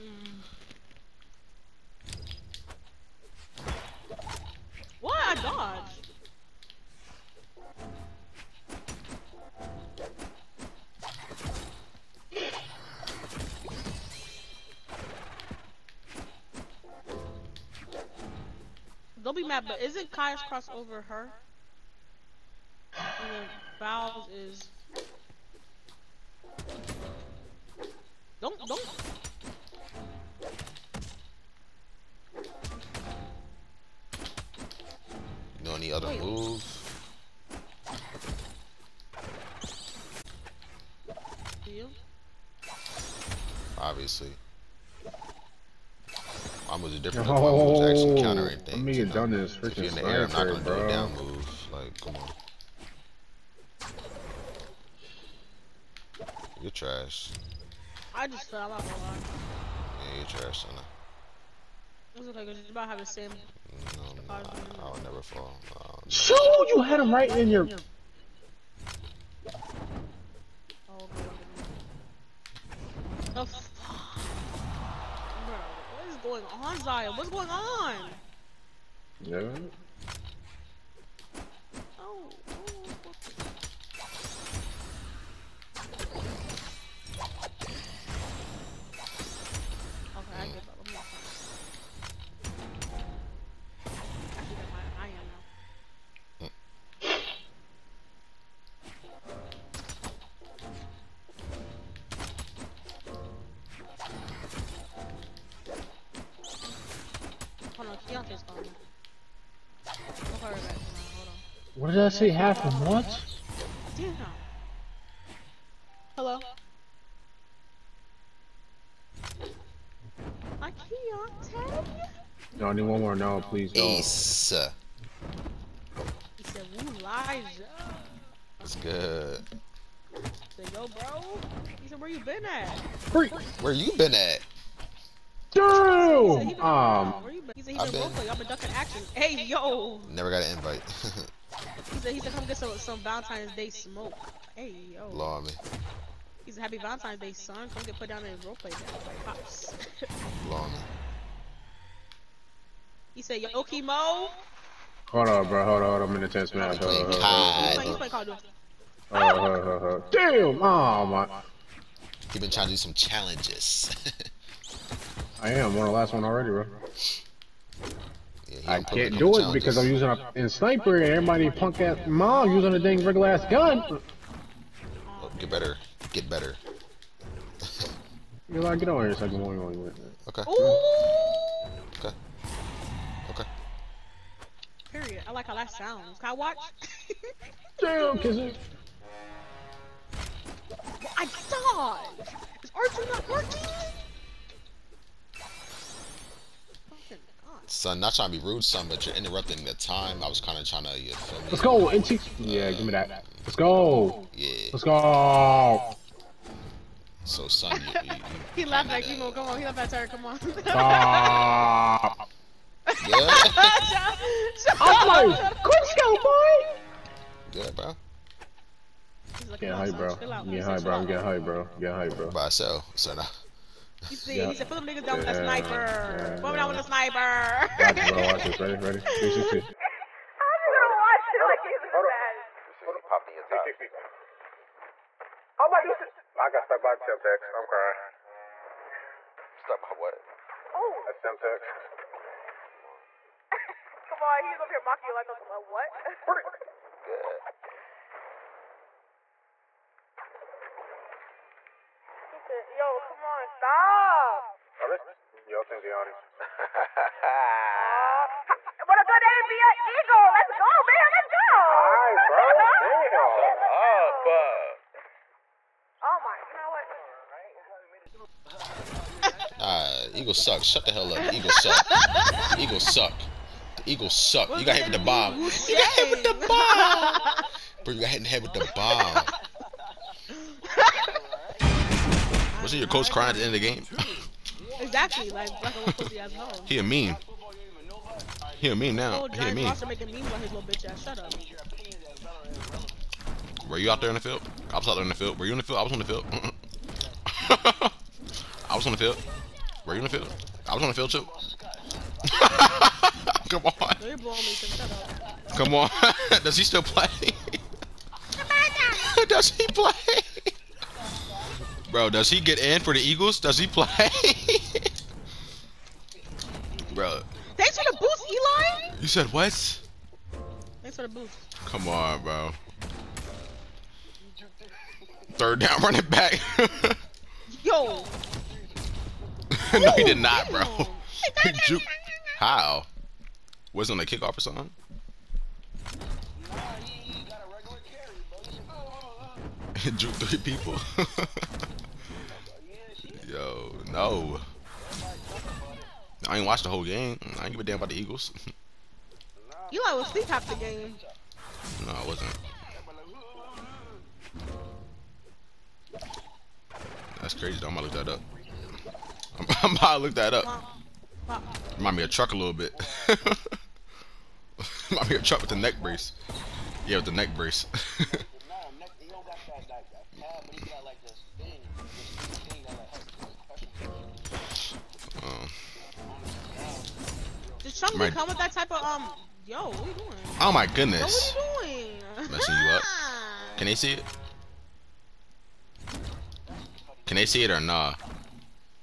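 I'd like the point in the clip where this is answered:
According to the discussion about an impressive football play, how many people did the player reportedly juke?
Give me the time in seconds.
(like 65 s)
340 s.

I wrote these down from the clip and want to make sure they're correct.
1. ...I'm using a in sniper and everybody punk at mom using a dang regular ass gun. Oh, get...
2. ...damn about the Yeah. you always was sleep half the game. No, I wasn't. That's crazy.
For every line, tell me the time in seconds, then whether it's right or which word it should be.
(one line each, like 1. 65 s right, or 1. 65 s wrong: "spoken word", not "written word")
1. 169 s right
2. 347 s wrong: "Eagles", not "Yeah".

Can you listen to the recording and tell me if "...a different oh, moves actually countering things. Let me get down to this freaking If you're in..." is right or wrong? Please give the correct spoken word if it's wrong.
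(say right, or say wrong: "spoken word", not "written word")
right.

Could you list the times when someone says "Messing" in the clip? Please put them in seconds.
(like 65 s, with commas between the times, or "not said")
382 s.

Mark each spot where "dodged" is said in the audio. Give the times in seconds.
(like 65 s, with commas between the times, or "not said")
5 s.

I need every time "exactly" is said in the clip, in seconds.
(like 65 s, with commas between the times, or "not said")
284 s.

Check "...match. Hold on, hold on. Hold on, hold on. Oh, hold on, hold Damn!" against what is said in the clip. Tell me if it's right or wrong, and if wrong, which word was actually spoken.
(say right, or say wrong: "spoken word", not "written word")
right.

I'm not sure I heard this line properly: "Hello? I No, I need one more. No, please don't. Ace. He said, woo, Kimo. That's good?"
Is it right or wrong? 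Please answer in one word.
wrong.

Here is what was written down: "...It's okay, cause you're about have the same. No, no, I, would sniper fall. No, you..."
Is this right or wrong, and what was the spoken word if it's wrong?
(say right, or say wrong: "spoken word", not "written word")
wrong: "never", not "sniper".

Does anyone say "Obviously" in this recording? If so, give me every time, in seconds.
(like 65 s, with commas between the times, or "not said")
43 s.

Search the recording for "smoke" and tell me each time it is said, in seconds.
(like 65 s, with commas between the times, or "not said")
143 s.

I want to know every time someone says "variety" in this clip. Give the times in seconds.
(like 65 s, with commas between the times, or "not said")
not said.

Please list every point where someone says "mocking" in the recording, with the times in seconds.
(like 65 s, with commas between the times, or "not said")
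244 s.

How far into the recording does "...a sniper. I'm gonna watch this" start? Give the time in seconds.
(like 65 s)
226 s.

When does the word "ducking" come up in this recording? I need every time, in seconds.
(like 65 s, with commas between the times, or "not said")
138 s.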